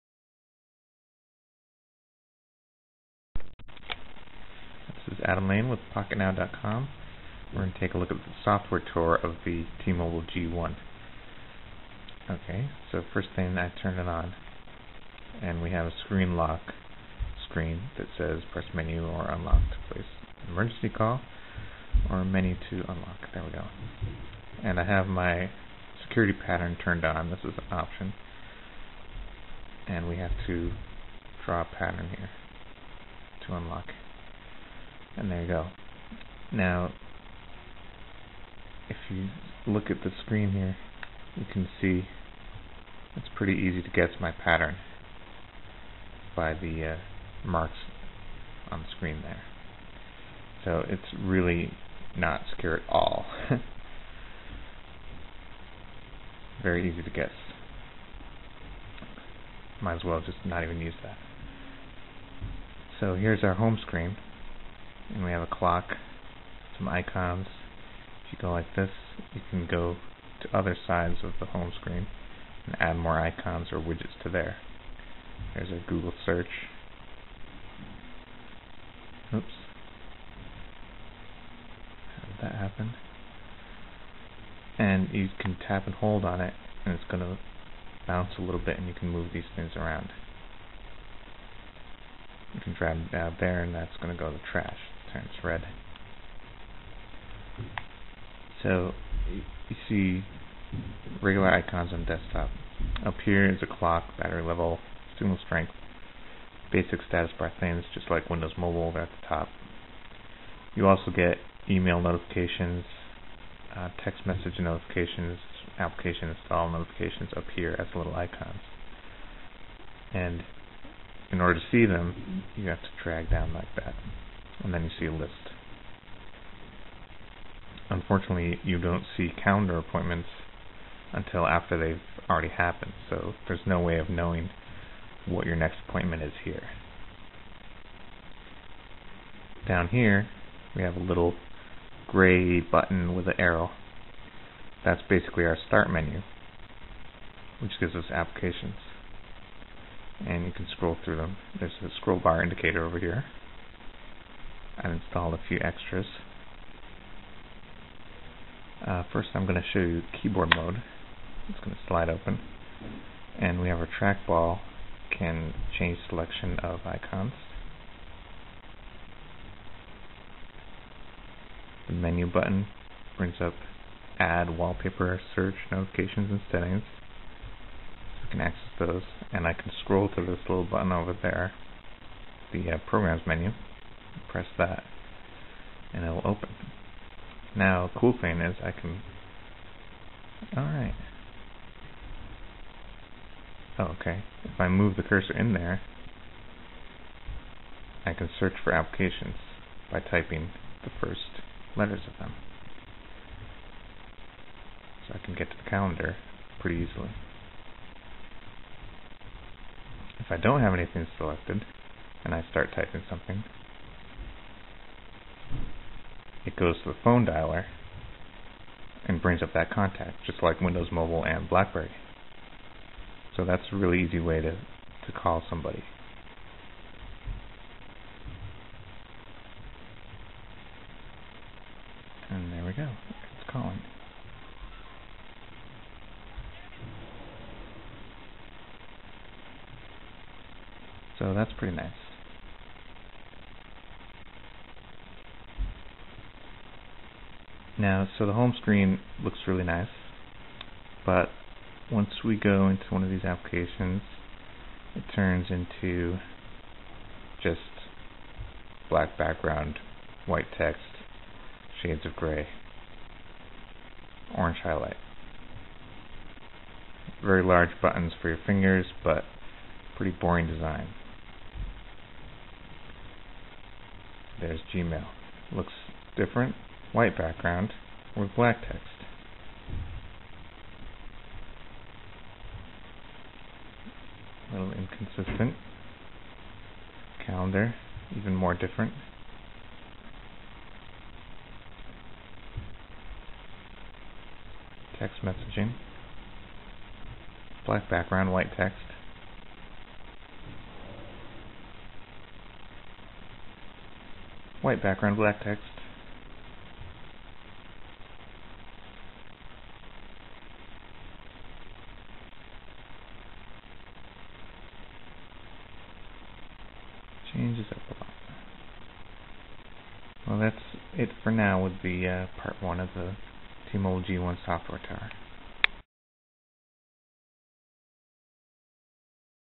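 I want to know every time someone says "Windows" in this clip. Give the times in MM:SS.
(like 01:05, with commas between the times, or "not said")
01:48, 03:40.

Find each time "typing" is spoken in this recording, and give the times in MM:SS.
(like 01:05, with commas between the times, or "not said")
03:19, 03:32.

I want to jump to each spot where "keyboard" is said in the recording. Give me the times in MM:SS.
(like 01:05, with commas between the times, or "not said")
02:40.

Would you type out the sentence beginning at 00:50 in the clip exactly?
So it's really not secure at all.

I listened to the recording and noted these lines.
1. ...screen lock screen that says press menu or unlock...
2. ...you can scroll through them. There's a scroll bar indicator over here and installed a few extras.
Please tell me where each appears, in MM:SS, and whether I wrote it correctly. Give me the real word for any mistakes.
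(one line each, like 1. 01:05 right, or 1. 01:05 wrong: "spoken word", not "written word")
1. 00:16 right
2. 02:30 right.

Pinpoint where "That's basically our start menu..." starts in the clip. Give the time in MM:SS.
02:24.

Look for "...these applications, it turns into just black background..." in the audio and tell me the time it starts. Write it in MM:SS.
04:13.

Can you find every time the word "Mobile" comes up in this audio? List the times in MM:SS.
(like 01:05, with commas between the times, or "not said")
00:09, 01:48, 03:40, 05:23.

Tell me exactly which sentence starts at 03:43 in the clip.
So that's a really easy way to, to call somebody.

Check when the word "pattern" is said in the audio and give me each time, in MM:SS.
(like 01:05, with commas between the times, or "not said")
00:26, 00:31, 00:44.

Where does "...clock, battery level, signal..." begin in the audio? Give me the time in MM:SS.
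01:43.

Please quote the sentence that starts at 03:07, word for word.
Now, cool thing is I can...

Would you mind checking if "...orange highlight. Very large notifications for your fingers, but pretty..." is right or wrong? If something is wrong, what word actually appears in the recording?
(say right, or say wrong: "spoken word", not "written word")
wrong: "buttons", not "notifications".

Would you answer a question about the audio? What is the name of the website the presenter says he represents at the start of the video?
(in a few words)
PocketNow.com.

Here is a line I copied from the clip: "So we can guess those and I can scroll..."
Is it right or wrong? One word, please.
wrong.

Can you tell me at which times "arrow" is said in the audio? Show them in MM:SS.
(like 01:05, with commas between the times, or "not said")
02:23.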